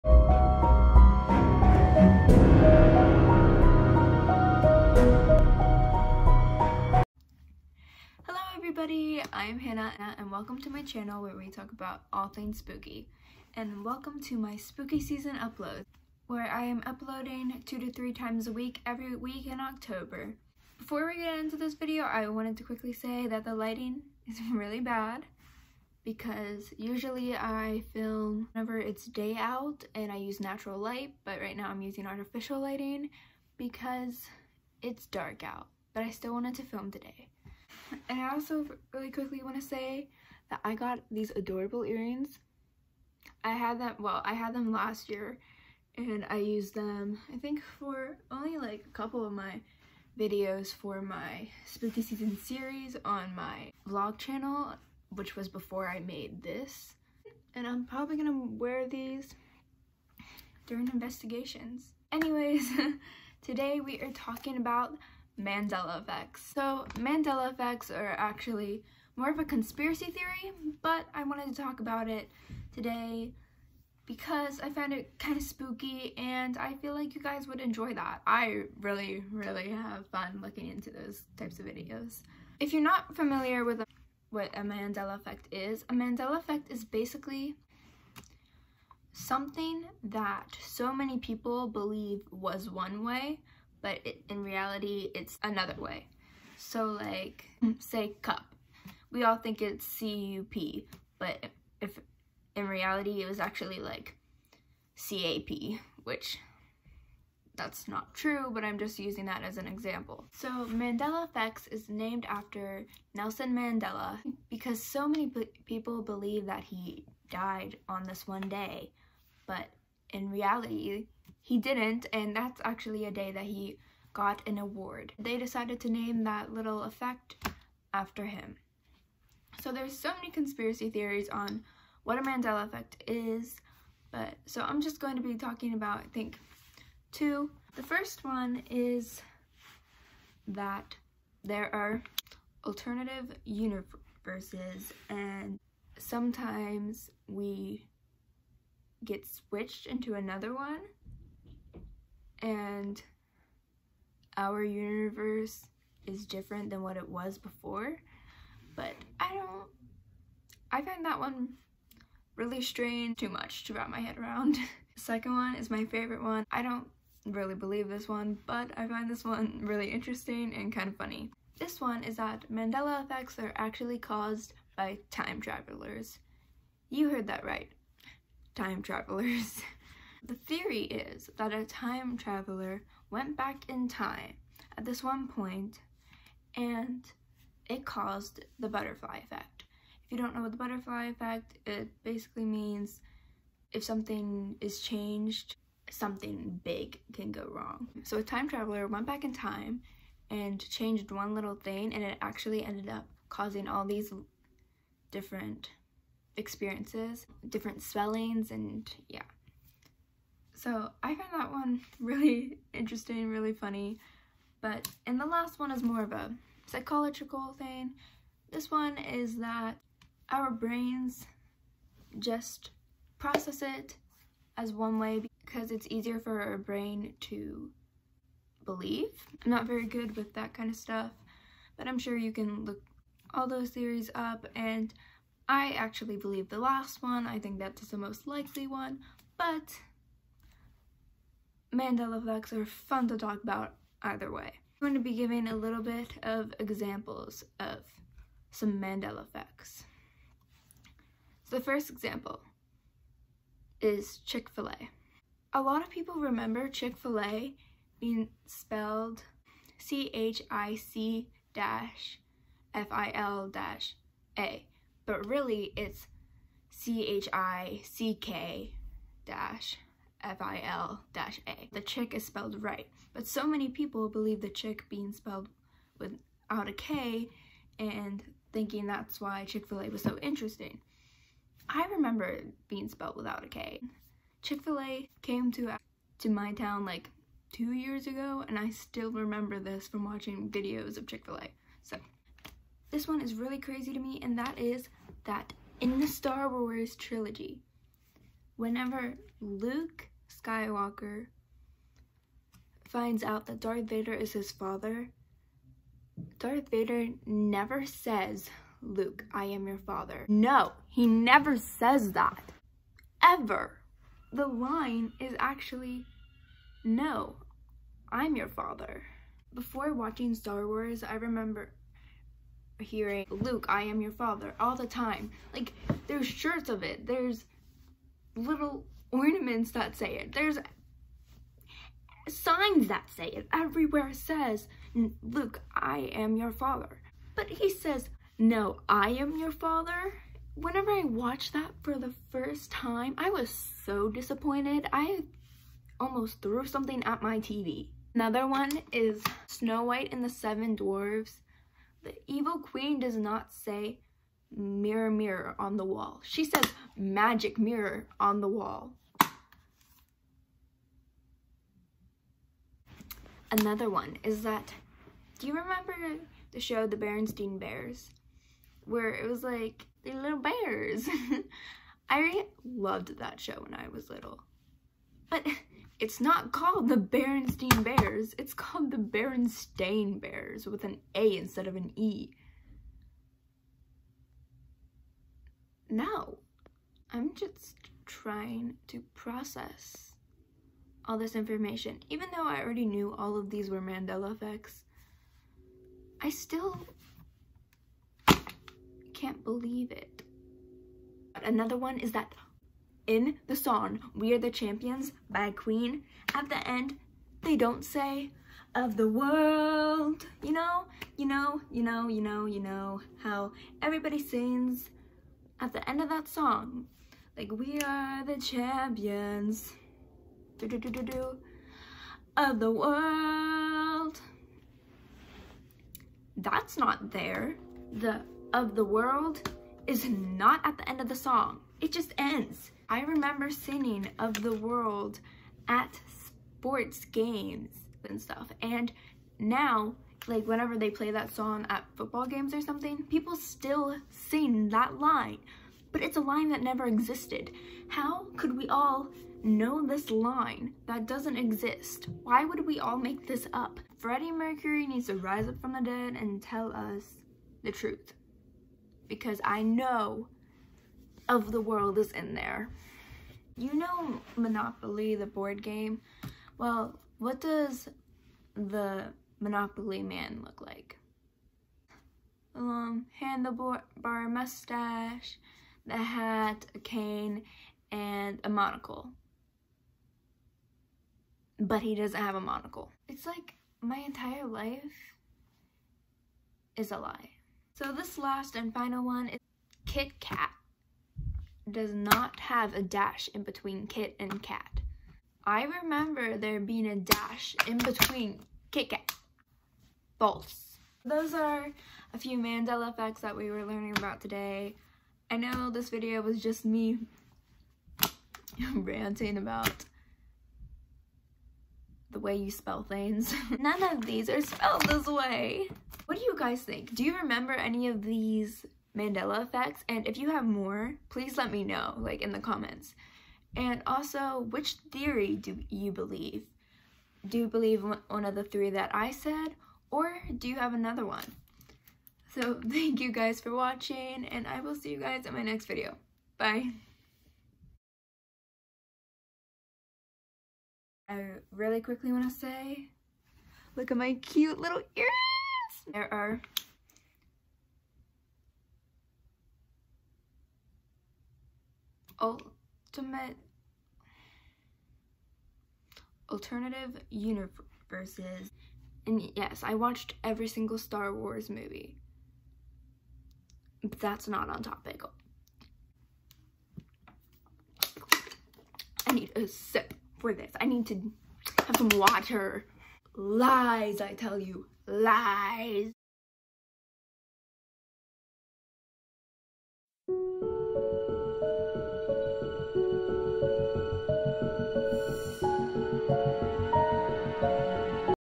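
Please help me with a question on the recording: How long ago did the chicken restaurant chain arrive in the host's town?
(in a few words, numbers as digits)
two years ago.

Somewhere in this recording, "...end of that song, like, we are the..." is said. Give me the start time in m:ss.
6:55.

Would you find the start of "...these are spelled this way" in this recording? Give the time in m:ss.
8:34.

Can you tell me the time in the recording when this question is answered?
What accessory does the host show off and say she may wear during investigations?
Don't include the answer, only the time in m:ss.
0:41.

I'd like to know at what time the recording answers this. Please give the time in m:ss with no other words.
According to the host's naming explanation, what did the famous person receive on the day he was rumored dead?
2:04.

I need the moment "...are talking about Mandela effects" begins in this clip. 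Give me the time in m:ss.
1:04.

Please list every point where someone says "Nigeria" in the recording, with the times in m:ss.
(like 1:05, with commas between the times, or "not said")
not said.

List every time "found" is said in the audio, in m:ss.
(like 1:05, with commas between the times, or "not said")
1:14, 3:31.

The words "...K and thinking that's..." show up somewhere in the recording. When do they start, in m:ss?
4:36.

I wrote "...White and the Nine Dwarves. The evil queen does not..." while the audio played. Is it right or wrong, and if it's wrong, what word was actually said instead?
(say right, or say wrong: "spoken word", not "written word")
wrong: "Seven", not "Nine".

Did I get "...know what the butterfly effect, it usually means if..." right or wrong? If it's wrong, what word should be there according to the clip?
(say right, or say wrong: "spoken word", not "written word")
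wrong: "basically", not "usually".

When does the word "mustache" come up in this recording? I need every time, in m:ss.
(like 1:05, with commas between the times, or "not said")
7:54.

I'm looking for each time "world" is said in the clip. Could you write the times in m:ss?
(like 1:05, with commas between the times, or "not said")
6:49, 7:02, 7:08, 7:14, 7:41.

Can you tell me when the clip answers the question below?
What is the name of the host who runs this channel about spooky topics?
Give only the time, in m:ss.
0:09.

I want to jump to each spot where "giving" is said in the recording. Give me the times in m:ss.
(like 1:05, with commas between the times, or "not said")
4:05.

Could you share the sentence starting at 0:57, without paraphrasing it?
And I'm probably gonna wear these during investigations.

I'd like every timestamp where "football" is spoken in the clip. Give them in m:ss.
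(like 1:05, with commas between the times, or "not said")
7:21.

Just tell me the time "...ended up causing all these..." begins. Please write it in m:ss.
3:22.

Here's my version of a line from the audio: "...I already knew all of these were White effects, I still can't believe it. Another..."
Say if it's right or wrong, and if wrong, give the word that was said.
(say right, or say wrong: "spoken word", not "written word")
wrong: "Mandela", not "White".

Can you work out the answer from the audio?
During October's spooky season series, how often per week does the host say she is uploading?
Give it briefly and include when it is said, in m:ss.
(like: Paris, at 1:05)
two to three times, at 0:17.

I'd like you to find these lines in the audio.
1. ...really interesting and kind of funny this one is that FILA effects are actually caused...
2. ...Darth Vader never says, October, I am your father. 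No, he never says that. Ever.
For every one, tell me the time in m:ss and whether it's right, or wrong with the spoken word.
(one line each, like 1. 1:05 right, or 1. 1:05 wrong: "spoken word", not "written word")
1. 2:49 wrong: "Mandela", not "FILA"
2. 5:06 wrong: "Luke", not "October".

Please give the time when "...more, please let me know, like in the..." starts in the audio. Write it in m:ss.
8:40.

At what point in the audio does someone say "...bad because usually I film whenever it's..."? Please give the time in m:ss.
0:24.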